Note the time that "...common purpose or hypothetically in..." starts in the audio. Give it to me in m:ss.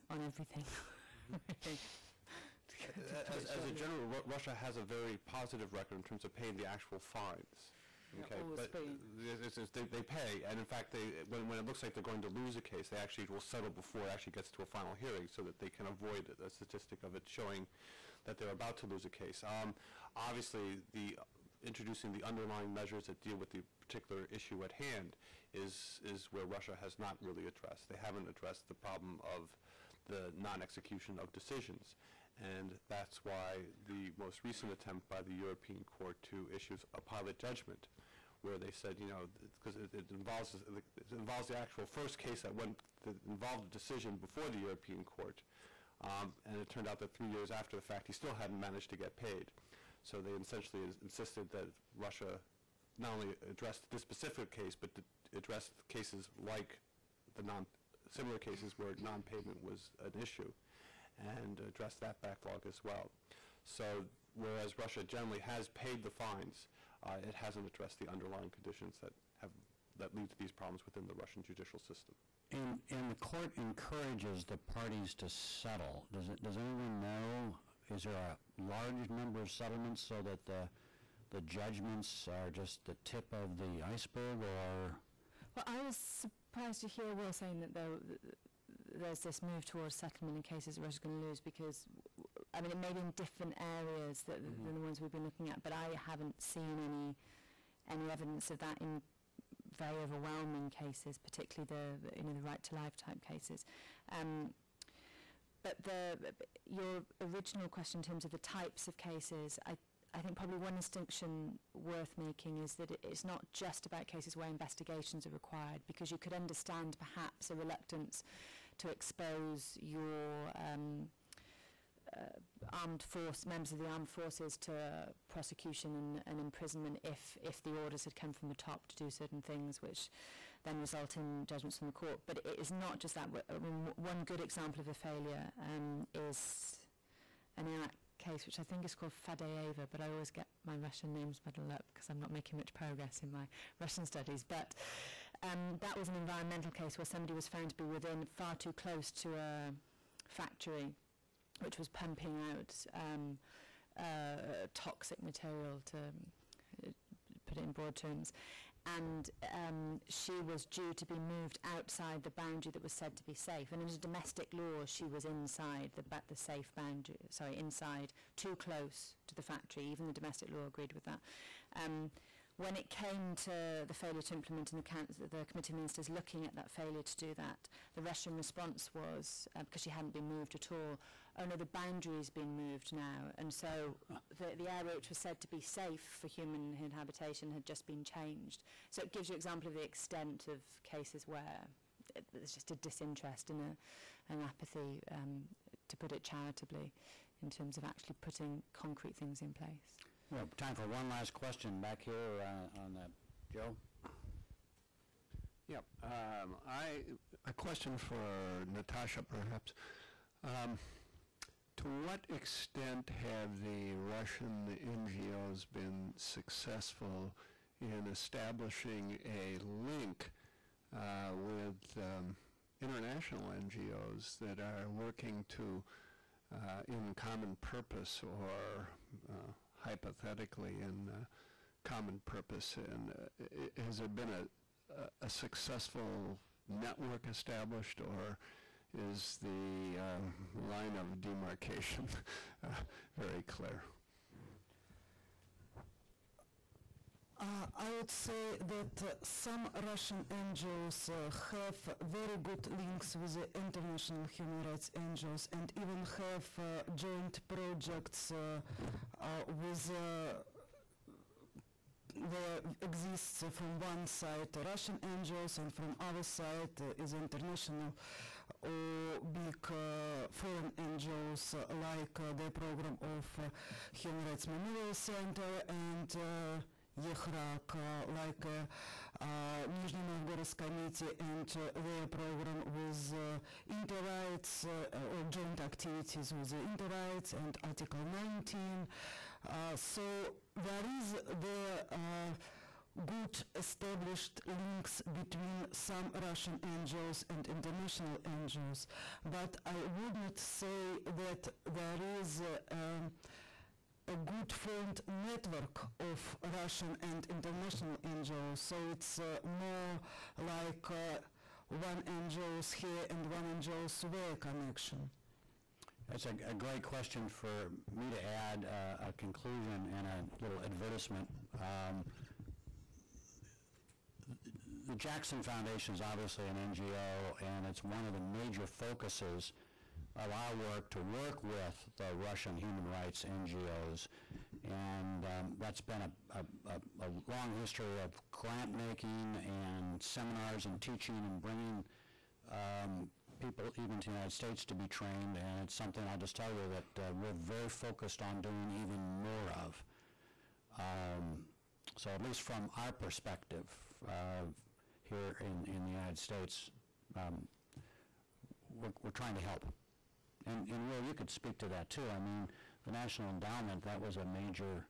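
3:47.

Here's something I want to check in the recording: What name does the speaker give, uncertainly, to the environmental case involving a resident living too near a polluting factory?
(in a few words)
Fadeeva.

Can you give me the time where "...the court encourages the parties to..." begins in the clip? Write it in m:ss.
1:13.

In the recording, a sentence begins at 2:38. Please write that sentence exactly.
And um, she was due to be moved outside the boundary that was said to be safe.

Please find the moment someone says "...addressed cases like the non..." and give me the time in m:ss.
0:55.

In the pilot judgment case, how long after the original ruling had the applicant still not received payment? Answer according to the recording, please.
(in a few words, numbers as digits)
3 years.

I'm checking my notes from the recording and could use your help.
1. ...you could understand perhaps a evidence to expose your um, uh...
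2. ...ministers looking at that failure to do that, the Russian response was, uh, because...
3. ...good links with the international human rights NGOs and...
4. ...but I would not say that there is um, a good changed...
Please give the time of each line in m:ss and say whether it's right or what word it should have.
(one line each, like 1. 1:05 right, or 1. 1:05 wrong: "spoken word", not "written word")
1. 1:56 wrong: "reluctance", not "evidence"
2. 2:55 right
3. 4:12 right
4. 4:59 wrong: "formed", not "changed".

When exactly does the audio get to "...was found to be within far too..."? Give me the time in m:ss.
2:27.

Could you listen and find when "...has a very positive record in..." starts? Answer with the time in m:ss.
0:04.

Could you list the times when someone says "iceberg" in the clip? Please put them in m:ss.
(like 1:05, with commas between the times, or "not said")
1:23.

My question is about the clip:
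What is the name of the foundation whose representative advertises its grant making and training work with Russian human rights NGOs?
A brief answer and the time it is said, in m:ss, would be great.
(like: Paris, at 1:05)
Jackson Foundation, at 5:24.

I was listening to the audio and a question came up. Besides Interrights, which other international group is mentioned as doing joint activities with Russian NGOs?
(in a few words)
Article 19.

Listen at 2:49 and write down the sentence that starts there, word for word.
Even the domestic law agreed with that.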